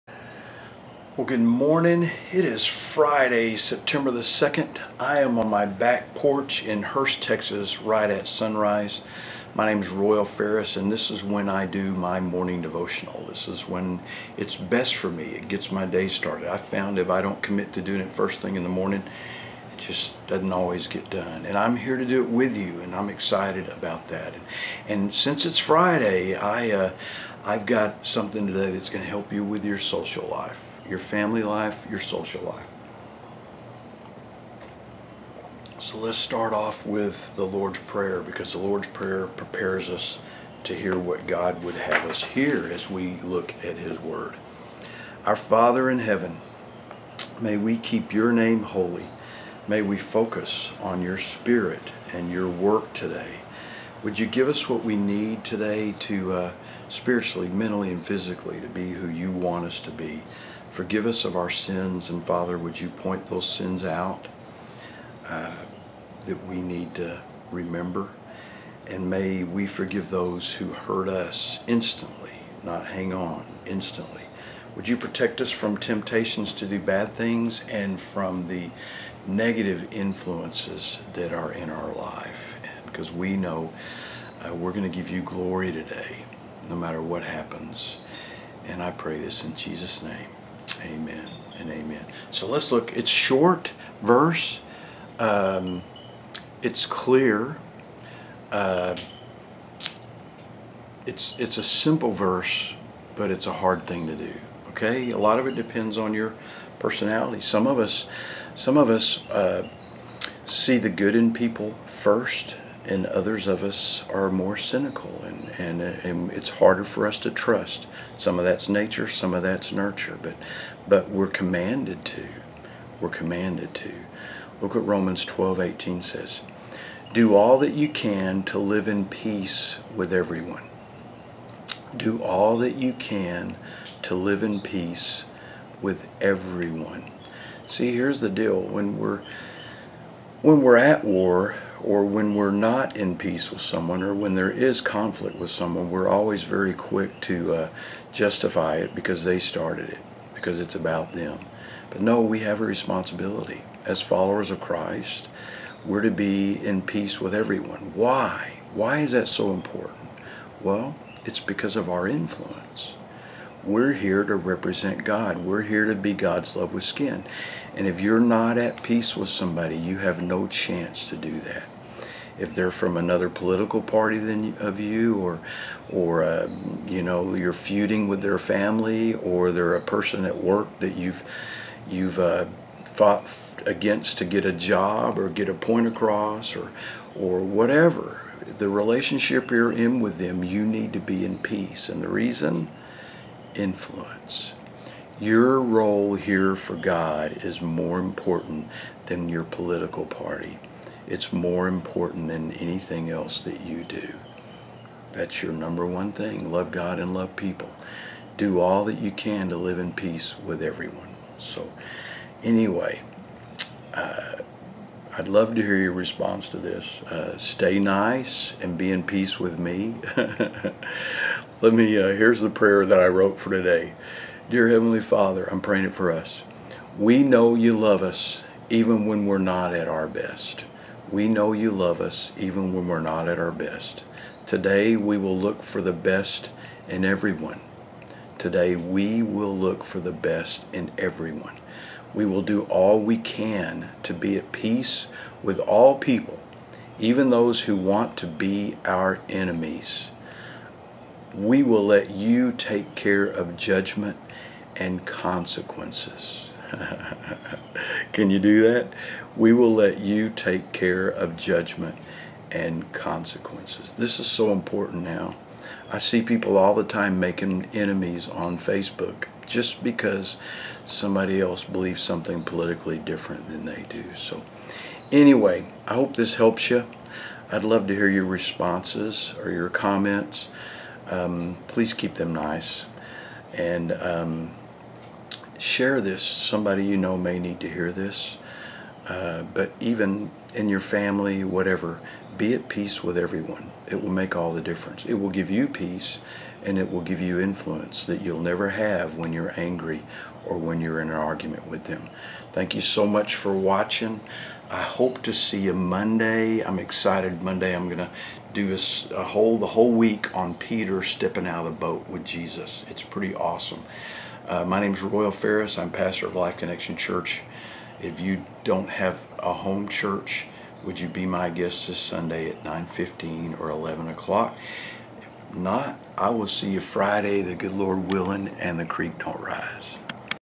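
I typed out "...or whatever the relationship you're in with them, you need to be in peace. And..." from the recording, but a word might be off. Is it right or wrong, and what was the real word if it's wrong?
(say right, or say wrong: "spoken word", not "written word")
right.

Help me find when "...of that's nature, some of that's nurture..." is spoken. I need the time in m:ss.
1:58.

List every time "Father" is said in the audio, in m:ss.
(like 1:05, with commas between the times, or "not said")
0:45, 1:02, 3:45.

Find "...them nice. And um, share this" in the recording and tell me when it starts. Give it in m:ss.
4:42.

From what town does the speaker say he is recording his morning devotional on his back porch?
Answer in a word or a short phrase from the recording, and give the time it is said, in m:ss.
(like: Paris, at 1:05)
Hurst, Texas, at 0:06.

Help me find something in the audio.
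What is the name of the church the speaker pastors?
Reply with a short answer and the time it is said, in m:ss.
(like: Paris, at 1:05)
Life Connection Church, at 5:16.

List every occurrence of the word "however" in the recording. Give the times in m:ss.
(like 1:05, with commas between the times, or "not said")
not said.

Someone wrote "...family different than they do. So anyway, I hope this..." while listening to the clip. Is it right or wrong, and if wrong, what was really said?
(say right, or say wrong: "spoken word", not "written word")
wrong: "politically", not "family".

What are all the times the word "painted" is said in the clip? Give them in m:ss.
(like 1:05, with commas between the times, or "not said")
not said.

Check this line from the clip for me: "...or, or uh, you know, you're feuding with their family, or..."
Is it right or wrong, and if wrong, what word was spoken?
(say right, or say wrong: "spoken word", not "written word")
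right.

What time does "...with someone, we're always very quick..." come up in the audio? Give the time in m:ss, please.
2:25.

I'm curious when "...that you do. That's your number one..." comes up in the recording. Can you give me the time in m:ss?
3:23.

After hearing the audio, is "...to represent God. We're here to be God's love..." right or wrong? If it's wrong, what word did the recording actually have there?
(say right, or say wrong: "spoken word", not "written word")
right.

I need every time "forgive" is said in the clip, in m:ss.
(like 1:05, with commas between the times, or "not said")
1:00, 1:09.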